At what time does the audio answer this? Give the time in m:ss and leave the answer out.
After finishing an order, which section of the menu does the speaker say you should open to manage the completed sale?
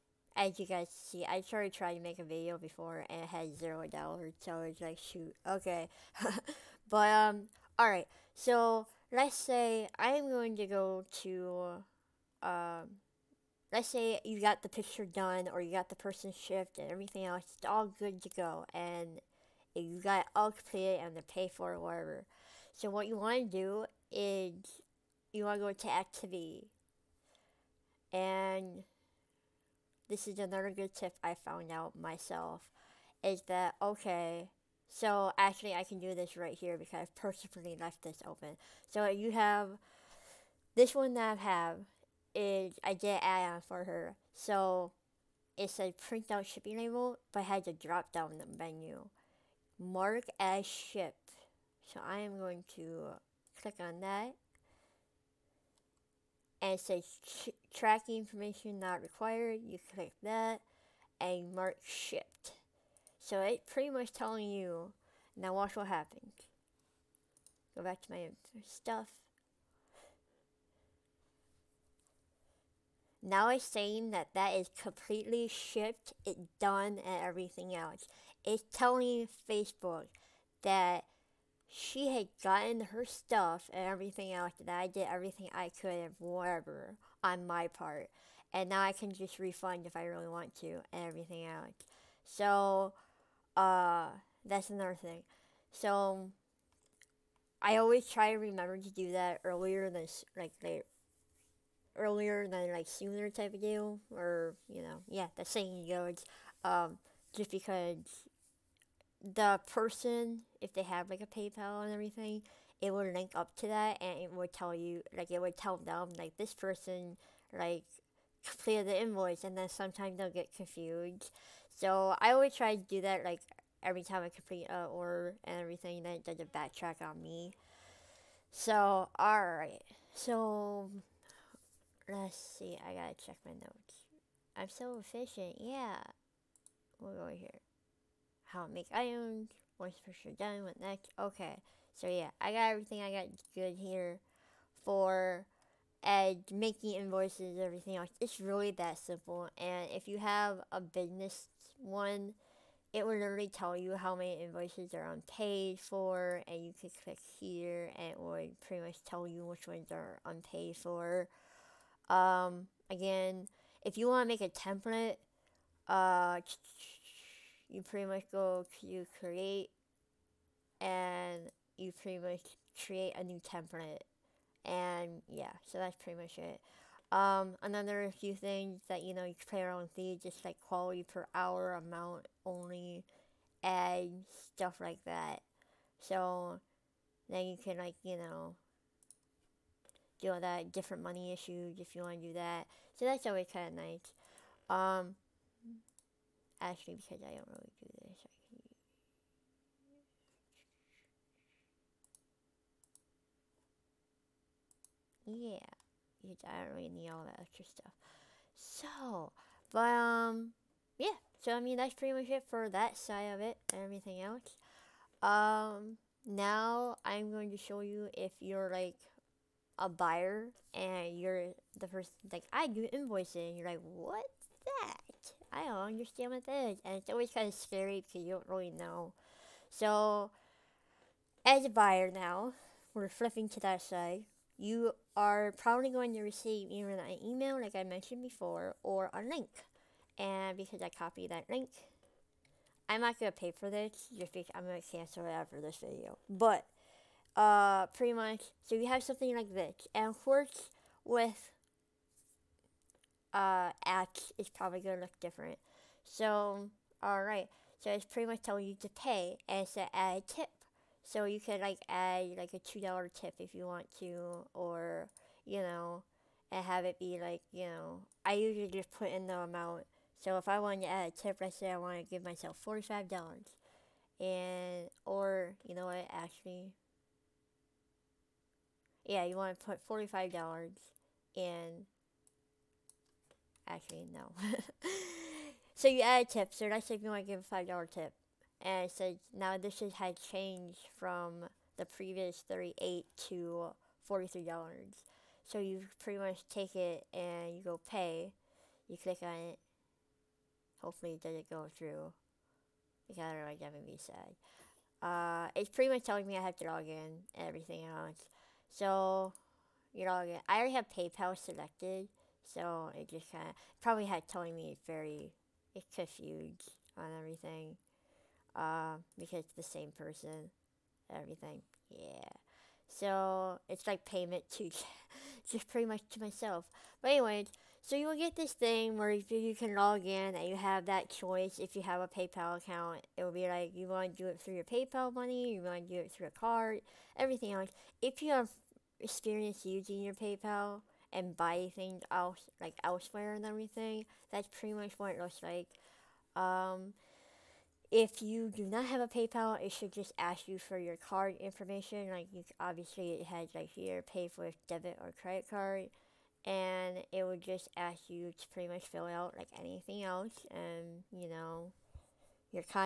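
0:25.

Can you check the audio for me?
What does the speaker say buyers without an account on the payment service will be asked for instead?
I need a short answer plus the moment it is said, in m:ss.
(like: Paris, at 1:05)
card information, at 5:50.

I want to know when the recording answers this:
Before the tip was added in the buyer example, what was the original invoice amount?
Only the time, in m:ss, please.
4:52.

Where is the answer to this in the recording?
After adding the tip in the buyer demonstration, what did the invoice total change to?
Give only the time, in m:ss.
4:54.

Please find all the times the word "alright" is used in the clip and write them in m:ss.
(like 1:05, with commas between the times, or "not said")
0:07, 2:09, 4:17.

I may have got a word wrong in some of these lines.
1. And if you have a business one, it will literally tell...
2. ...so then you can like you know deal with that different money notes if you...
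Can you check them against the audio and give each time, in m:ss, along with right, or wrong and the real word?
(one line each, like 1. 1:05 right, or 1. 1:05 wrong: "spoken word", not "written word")
1. 2:29 right
2. 3:06 wrong: "issues", not "notes".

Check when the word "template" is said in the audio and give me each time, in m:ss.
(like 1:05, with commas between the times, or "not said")
2:44, 2:53.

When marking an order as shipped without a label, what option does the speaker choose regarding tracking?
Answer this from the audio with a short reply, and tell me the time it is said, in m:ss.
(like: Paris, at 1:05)
tracking information not required, at 0:57.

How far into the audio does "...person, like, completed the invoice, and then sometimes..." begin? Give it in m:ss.
1:56.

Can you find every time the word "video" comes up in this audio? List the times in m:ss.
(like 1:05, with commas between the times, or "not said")
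0:02, 4:05.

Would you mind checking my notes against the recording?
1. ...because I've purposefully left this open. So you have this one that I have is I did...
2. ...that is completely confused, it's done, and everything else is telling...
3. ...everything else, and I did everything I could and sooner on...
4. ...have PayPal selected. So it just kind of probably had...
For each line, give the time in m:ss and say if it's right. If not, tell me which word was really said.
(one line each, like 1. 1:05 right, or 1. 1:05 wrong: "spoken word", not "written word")
1. 0:36 right
2. 1:14 wrong: "shipped", not "confused"
3. 1:23 wrong: "whatever", not "sooner"
4. 5:10 right.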